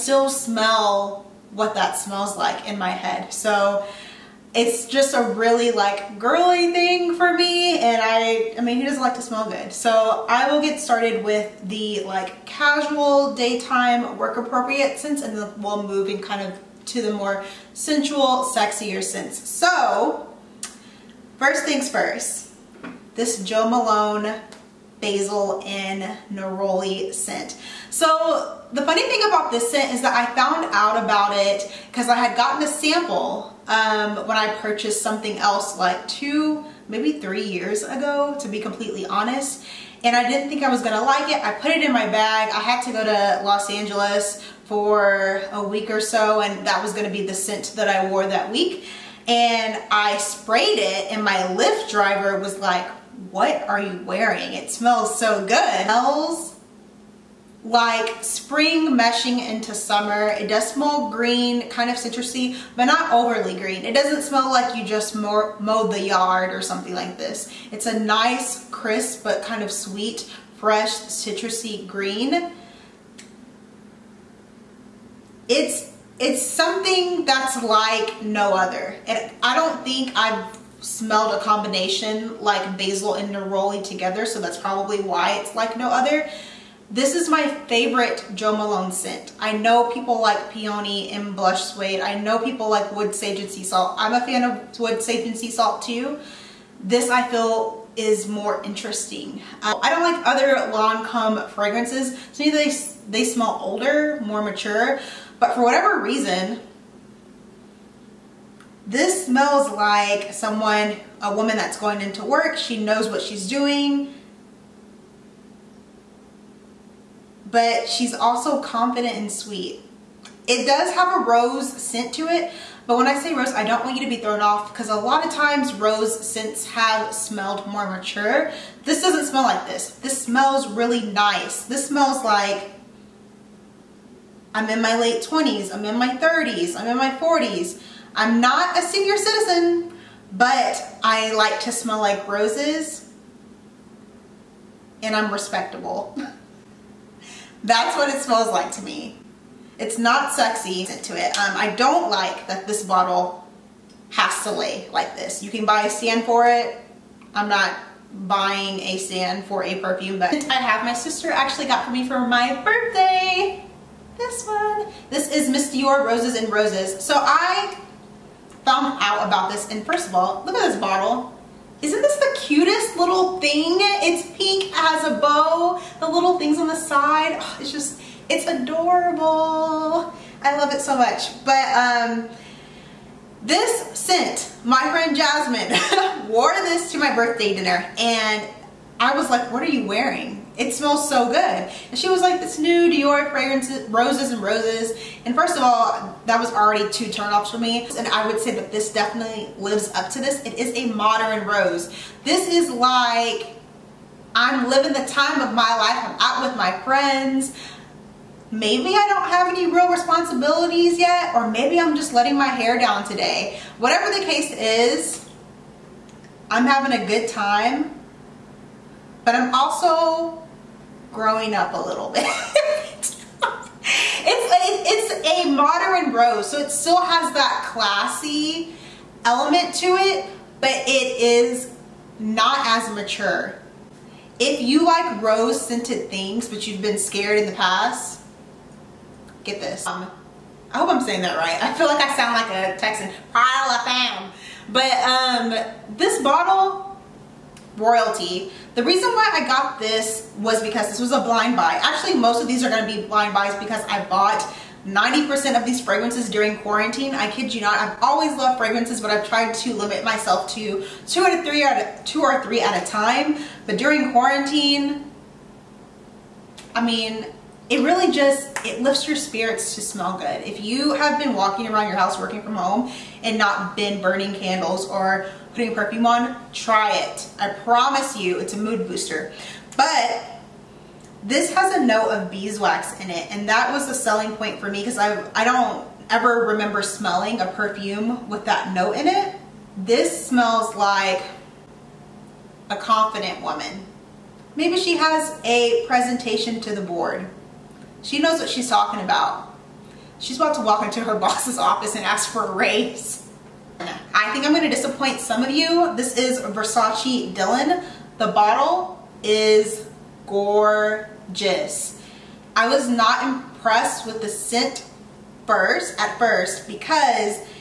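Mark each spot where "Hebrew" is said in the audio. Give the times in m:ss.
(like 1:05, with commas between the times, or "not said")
not said.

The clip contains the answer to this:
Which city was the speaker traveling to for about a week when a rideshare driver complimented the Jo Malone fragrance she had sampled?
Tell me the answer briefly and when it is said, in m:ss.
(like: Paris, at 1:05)
Los Angeles, at 0:43.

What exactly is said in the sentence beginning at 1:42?
To me, they, they smell older, more mature, but for whatever reason, this smells like someone, a woman that's going into work.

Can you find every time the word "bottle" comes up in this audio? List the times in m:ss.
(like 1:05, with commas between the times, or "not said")
2:32, 2:50, 4:06, 5:08.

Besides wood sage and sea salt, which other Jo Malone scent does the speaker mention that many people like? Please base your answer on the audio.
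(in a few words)
Blush suede.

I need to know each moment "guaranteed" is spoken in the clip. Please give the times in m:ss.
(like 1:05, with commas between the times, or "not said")
not said.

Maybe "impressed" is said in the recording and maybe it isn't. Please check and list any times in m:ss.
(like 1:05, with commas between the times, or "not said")
5:13.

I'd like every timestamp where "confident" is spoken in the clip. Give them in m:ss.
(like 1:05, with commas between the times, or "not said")
1:58, 4:52.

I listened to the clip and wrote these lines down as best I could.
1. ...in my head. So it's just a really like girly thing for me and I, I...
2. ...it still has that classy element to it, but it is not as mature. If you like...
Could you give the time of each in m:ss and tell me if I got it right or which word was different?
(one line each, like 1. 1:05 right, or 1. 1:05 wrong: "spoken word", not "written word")
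1. 0:02 right
2. 3:46 right.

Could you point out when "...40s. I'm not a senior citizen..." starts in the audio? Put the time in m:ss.
2:17.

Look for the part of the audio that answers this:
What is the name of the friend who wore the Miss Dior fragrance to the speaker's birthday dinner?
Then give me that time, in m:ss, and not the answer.
3:05.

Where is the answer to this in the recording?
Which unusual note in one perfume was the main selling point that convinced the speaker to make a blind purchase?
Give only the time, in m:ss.
4:42.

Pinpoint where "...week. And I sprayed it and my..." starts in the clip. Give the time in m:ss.
0:48.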